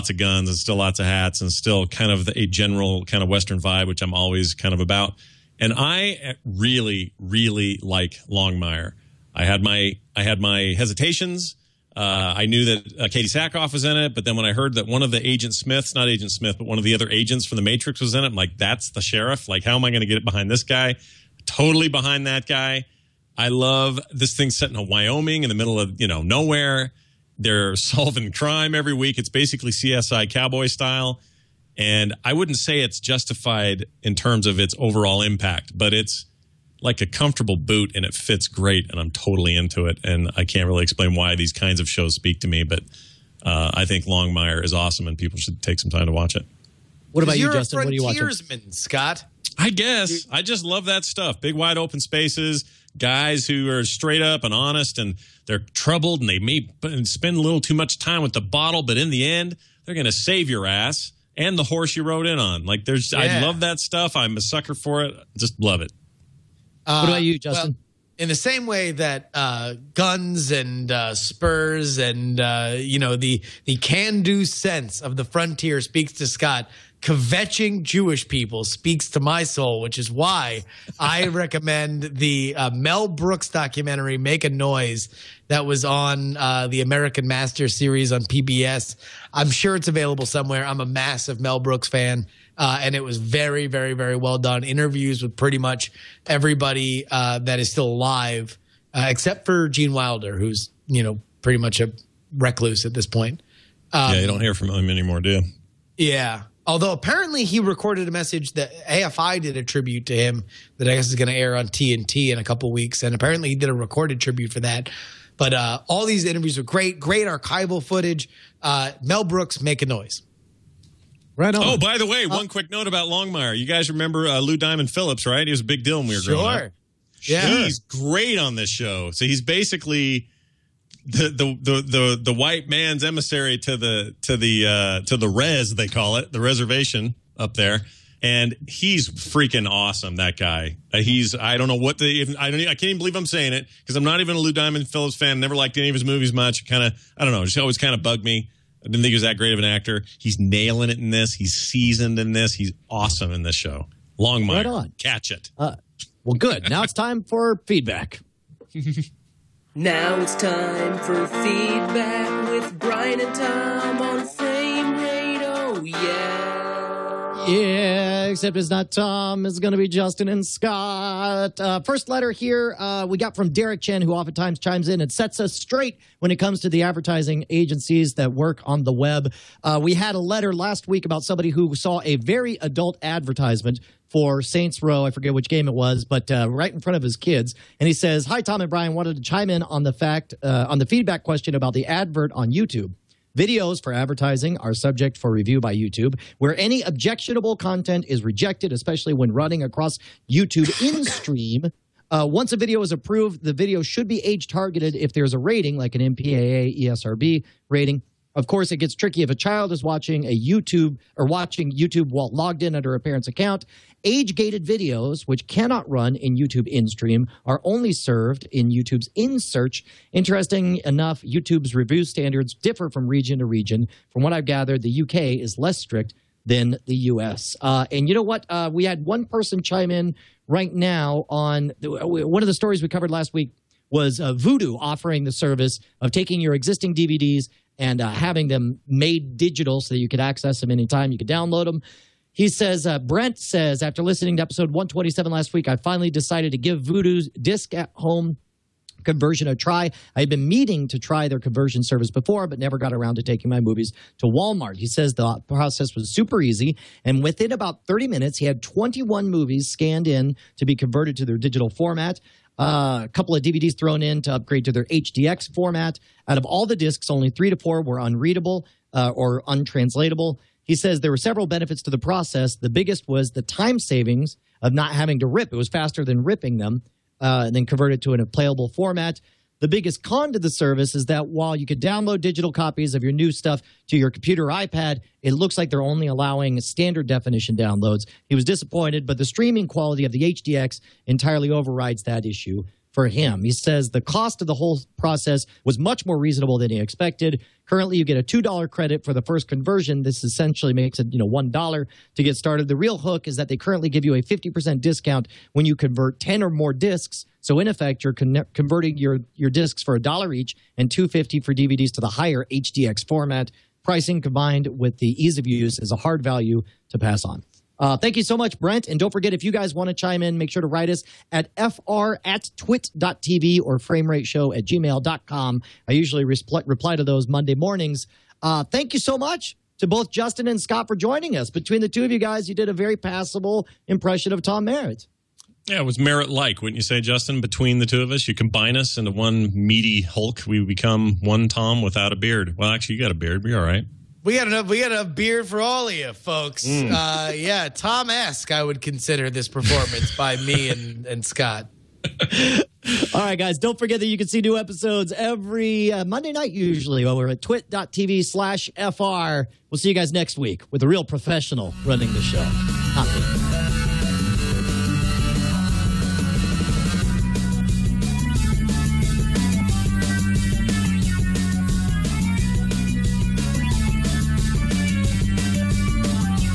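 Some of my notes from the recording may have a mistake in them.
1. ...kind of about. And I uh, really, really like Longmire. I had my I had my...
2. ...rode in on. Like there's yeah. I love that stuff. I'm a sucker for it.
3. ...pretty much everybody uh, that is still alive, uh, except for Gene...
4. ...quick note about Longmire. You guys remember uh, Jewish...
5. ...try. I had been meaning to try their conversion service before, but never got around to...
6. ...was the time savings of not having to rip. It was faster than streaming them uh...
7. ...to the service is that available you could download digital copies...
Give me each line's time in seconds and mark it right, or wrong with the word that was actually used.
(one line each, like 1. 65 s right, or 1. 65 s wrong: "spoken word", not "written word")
1. 4 s right
2. 62 s right
3. 95 s right
4. 122 s wrong: "Lou", not "Jewish"
5. 249 s right
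6. 273 s wrong: "ripping", not "streaming"
7. 280 s wrong: "while", not "available".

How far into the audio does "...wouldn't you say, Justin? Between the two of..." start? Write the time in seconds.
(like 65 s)
336 s.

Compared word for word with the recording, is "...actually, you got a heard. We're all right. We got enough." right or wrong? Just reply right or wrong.
wrong.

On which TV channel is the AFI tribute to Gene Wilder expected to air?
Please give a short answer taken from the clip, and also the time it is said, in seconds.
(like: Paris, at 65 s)
TNT, at 111 s.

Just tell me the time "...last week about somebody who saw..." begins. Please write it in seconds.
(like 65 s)
180 s.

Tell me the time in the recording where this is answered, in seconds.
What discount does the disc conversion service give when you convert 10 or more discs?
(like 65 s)
304 s.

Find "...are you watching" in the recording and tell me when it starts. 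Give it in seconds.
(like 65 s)
47 s.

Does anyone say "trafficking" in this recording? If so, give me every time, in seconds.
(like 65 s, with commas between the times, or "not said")
not said.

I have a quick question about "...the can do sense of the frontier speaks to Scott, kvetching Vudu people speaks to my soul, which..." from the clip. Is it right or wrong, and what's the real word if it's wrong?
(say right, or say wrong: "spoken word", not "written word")
wrong: "Jewish", not "Vudu".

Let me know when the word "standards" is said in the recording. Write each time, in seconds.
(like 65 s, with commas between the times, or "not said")
222 s, 286 s.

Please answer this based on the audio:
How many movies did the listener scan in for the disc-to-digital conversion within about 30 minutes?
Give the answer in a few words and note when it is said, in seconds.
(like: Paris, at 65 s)
21, at 258 s.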